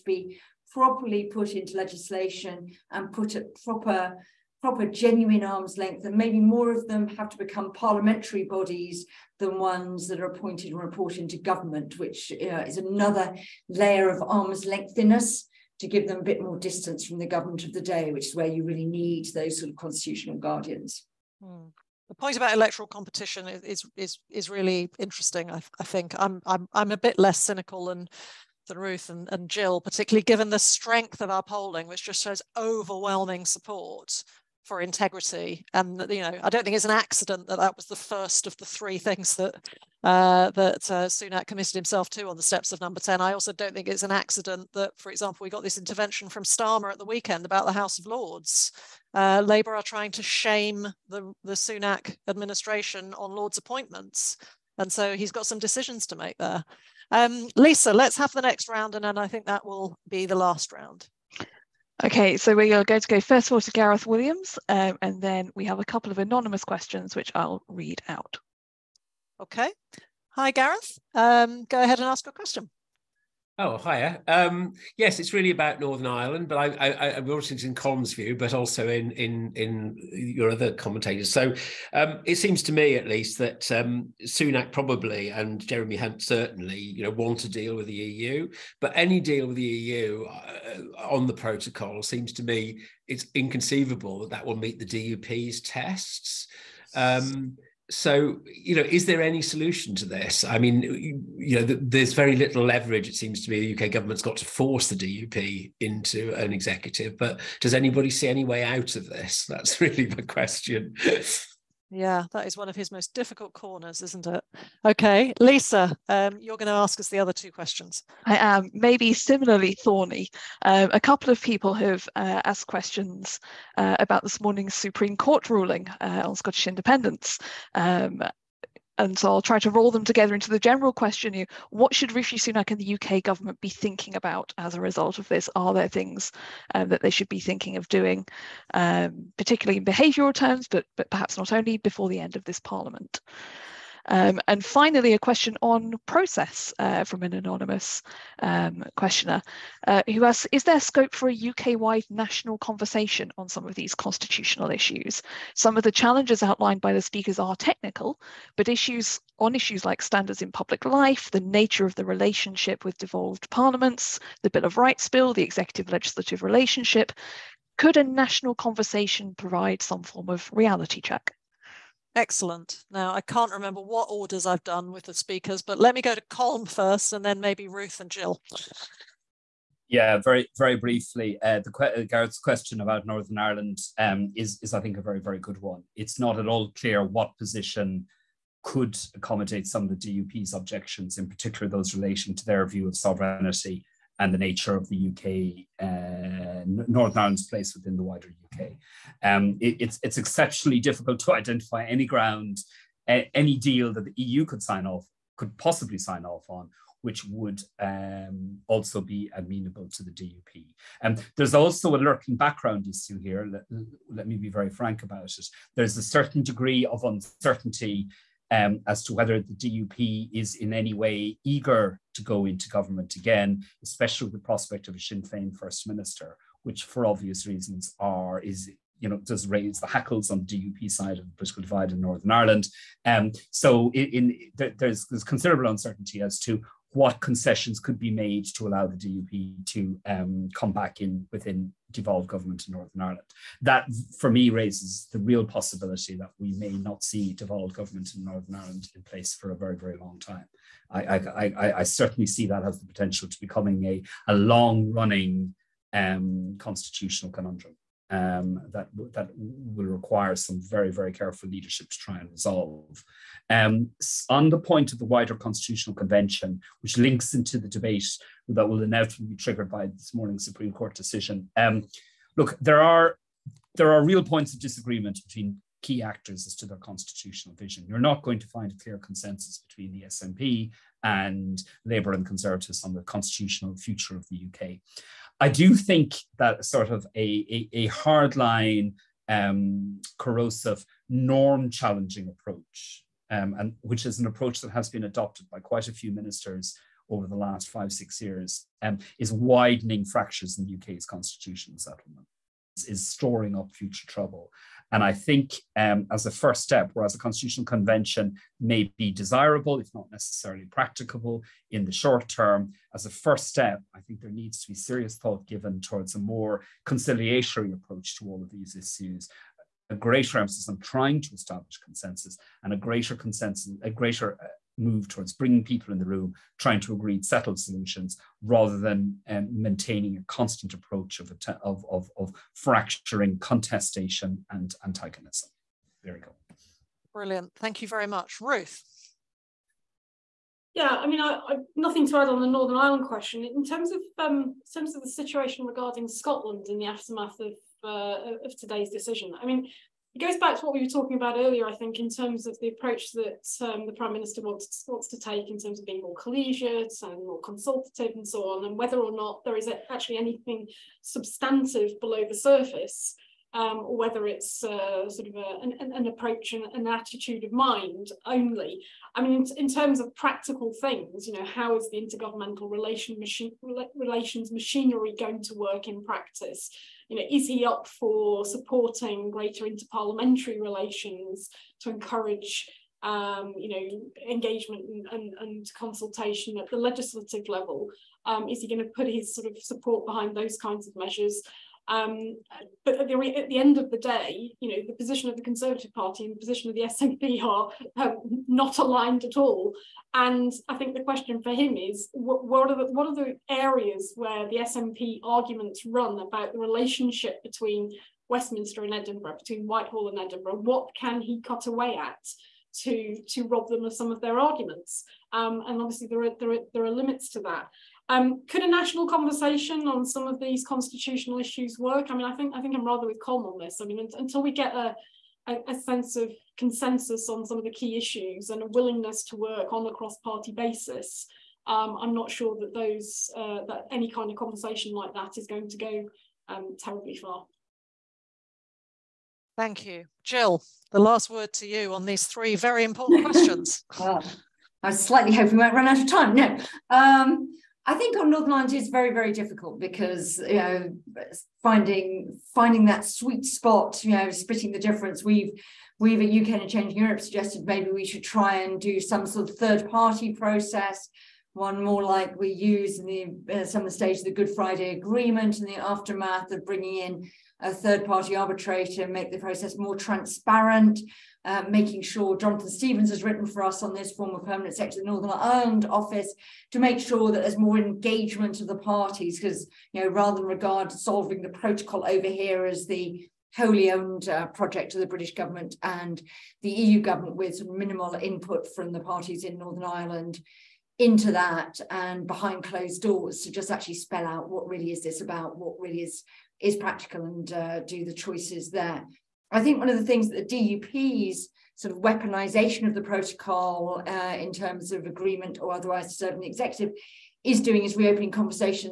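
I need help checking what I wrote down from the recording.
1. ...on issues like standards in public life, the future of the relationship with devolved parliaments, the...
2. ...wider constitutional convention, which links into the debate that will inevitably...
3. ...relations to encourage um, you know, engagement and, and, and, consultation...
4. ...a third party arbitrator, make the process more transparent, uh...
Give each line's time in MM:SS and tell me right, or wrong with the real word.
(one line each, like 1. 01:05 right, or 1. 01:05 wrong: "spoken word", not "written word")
1. 02:39 wrong: "nature", not "future"
2. 04:25 right
3. 06:20 right
4. 07:47 right.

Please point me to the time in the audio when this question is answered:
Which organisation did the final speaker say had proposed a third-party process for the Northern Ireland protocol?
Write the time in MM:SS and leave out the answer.
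07:36.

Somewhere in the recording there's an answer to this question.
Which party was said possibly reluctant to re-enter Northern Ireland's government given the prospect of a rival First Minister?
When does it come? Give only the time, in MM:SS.
03:44.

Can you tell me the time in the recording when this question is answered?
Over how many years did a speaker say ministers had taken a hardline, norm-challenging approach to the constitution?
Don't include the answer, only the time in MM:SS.
04:57.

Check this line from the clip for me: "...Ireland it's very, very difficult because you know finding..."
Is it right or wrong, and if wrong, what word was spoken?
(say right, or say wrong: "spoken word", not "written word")
right.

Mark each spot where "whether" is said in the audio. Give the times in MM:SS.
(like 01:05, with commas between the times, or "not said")
03:39, 05:58, 06:03.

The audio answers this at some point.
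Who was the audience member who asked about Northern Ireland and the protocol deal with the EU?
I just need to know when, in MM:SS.
01:03.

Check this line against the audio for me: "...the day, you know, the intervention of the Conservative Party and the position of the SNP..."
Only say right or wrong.
wrong.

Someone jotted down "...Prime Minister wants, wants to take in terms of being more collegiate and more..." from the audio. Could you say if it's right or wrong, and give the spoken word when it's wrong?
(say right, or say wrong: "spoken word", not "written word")
right.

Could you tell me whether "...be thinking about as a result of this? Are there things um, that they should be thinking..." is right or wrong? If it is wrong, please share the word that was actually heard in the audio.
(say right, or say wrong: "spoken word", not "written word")
right.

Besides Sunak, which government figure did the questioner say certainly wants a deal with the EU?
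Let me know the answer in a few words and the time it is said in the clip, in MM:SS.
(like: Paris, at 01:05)
Jeremy Hunt, at 01:25.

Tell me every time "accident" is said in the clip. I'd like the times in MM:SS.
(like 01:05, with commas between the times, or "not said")
00:36, 00:44.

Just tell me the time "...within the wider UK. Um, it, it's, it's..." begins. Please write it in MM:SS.
03:17.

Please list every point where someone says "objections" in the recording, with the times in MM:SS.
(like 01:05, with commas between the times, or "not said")
03:10.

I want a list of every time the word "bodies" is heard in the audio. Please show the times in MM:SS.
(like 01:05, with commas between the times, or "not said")
00:08.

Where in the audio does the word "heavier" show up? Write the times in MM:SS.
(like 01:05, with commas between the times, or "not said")
not said.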